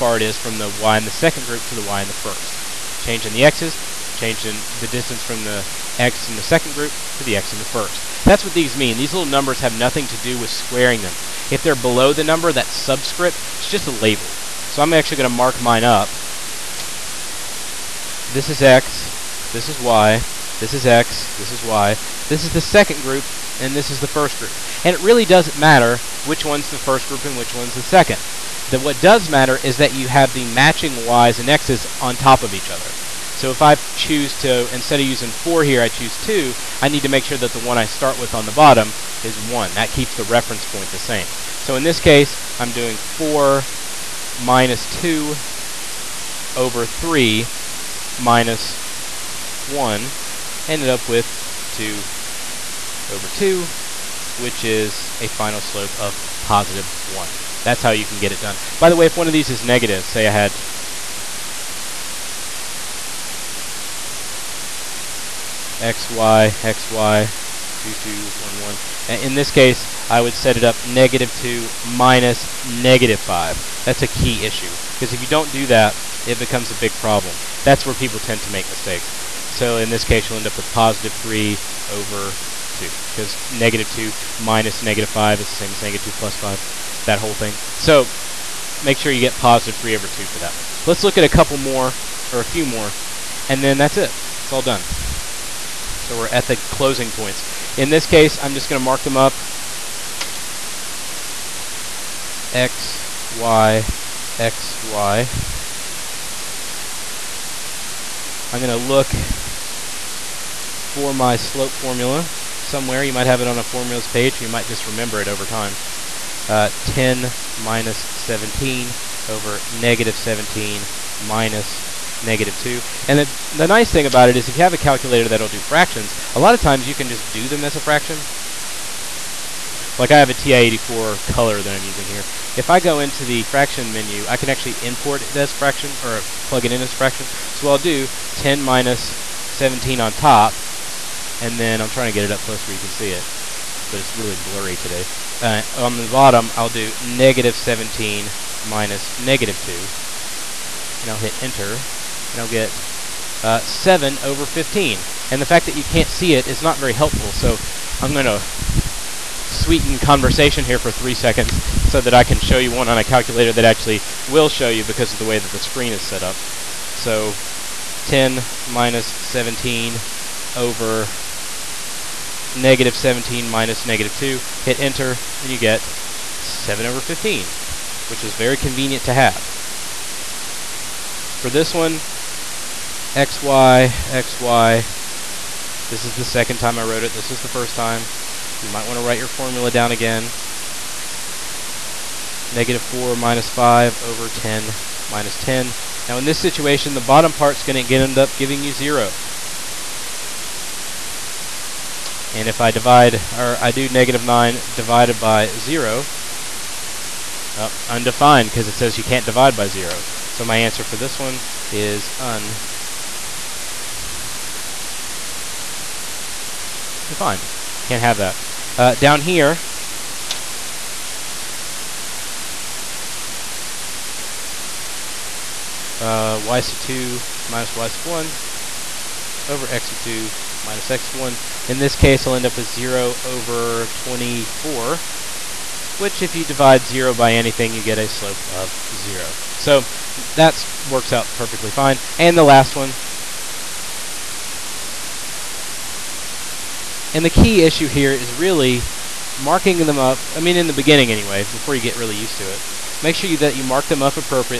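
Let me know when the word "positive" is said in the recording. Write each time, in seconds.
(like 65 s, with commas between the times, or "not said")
56 s, 80 s, 89 s.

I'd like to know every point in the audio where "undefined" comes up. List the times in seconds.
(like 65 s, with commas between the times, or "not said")
207 s, 212 s.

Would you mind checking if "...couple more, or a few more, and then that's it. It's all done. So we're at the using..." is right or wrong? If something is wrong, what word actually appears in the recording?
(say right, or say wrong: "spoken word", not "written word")
wrong: "closing", not "using".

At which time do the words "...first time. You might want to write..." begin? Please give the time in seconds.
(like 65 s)
187 s.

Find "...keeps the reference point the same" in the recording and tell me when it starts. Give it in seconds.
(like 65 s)
39 s.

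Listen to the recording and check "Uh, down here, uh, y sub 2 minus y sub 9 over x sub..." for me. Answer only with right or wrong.
wrong.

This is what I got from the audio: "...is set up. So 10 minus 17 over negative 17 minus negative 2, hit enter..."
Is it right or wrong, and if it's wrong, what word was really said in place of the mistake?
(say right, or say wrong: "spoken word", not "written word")
right.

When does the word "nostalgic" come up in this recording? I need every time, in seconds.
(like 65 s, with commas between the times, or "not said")
not said.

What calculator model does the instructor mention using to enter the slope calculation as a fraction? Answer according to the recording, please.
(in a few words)
TI-84 color.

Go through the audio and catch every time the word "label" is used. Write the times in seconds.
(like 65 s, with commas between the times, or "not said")
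13 s.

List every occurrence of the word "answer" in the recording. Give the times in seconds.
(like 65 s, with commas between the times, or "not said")
210 s.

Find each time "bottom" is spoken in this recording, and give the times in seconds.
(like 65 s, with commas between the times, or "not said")
38 s, 146 s, 197 s.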